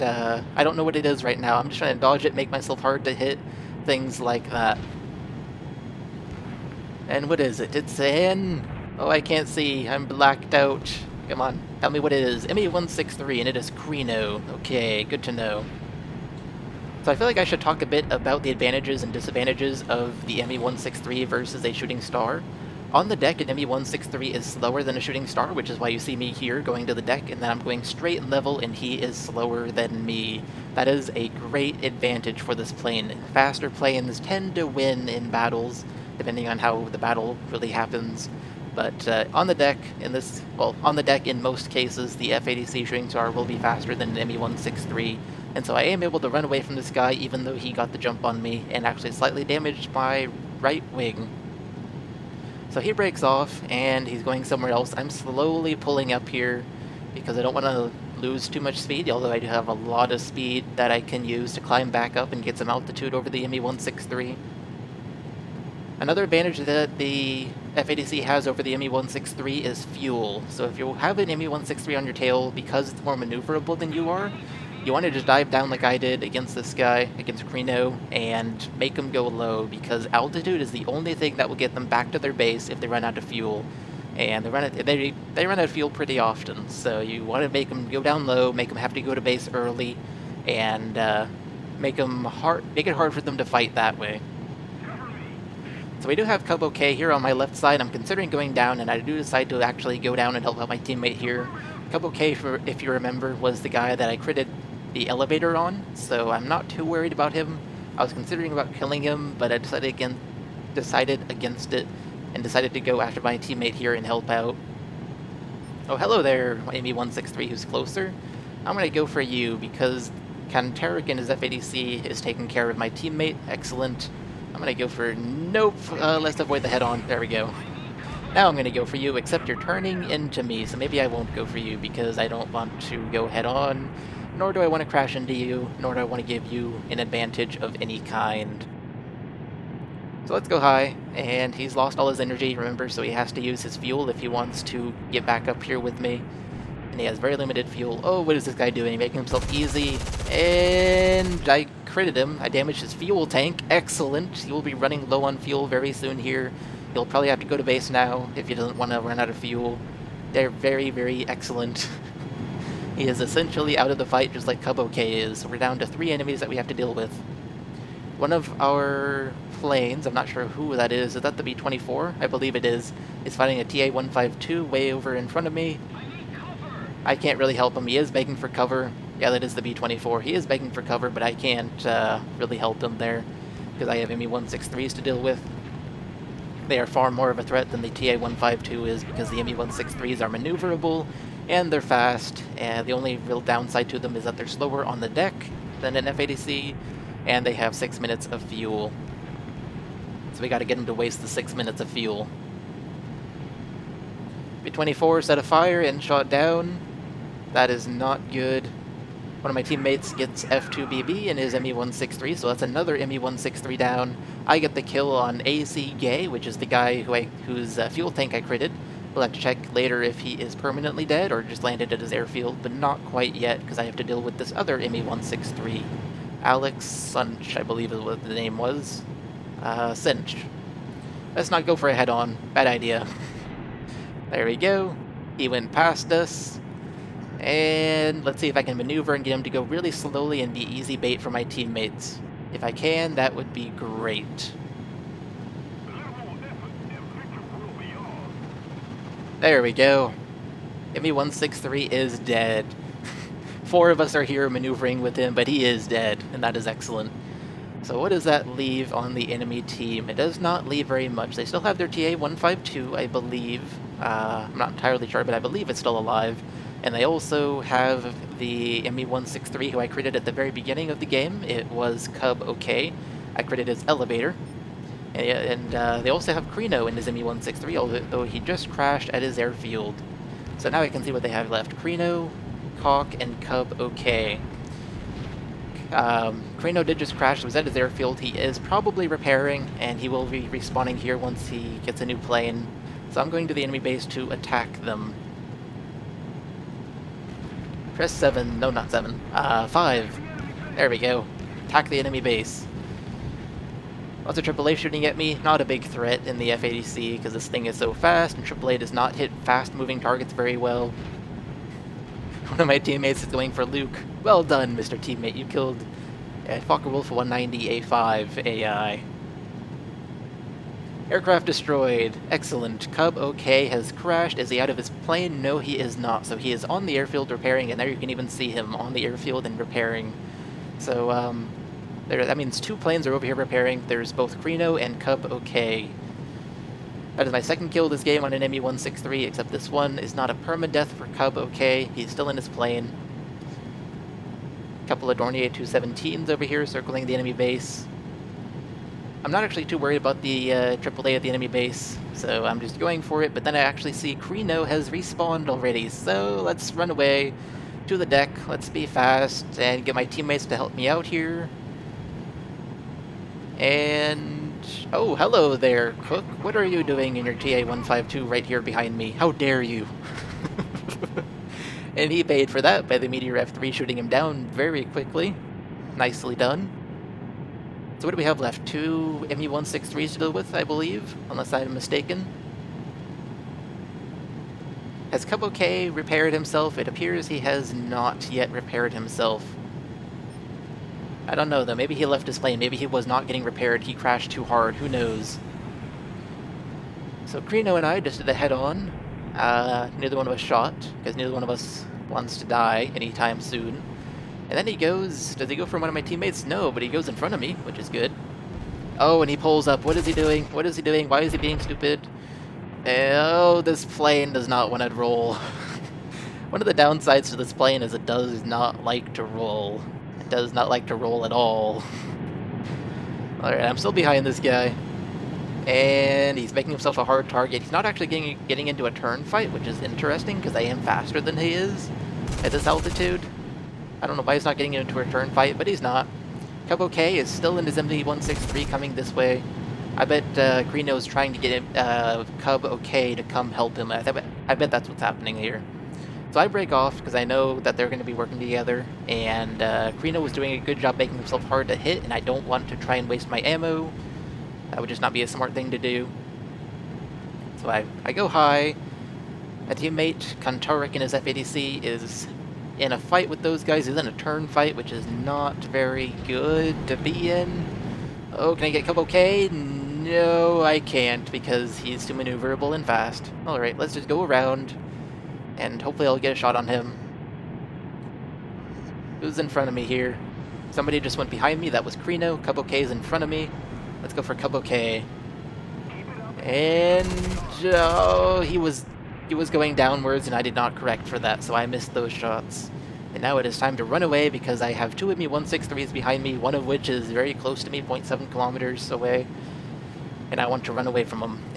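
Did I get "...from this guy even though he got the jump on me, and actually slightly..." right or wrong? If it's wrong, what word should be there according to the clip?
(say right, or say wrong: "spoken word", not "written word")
right.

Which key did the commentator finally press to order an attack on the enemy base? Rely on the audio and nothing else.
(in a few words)
5.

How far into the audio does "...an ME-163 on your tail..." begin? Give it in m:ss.
1:11.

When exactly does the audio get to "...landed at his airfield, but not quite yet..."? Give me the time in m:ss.
3:41.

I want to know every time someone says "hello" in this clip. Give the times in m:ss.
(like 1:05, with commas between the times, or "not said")
1:55, 6:05.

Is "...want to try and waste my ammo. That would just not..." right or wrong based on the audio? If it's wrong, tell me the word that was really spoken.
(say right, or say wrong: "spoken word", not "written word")
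right.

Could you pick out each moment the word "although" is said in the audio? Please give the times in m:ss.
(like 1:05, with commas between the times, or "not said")
0:59, 4:37.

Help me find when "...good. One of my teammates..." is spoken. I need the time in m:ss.
3:28.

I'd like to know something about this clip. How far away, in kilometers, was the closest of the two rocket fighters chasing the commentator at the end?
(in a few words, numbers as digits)
0.7 km.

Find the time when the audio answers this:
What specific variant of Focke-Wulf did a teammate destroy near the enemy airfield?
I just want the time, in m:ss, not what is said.
5:16.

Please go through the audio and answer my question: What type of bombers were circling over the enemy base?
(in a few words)
Dornier 217.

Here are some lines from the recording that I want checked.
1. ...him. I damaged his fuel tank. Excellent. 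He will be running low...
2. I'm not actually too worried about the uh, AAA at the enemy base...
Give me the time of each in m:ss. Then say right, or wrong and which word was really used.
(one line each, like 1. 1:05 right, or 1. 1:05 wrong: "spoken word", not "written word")
1. 2:32 right
2. 5:49 right.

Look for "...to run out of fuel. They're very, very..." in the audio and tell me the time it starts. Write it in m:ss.
2:38.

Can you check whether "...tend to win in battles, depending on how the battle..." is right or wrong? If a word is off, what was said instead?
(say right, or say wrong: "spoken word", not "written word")
right.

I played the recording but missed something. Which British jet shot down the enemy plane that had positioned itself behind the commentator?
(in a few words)
Meteor F3.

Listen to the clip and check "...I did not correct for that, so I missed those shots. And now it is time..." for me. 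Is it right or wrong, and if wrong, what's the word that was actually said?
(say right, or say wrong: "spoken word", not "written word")
right.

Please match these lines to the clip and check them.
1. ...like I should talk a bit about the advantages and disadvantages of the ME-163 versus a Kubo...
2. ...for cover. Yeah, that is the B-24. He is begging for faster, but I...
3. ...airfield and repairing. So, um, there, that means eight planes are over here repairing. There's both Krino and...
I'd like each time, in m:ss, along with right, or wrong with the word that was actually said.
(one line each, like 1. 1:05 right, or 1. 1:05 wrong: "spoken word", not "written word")
1. 0:17 wrong: "Shooting", not "Kubo"
2. 2:58 wrong: "cover", not "faster"
3. 5:29 wrong: "two", not "eight".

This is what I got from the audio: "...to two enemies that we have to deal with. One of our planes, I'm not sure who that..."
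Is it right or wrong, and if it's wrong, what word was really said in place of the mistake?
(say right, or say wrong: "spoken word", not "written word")
wrong: "three", not "two".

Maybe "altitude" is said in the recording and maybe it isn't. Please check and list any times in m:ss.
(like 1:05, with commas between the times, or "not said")
1:02, 1:20, 7:12.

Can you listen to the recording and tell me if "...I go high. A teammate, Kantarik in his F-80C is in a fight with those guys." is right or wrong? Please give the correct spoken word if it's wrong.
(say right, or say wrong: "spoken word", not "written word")
right.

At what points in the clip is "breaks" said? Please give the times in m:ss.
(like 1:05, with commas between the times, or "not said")
0:52, 7:26.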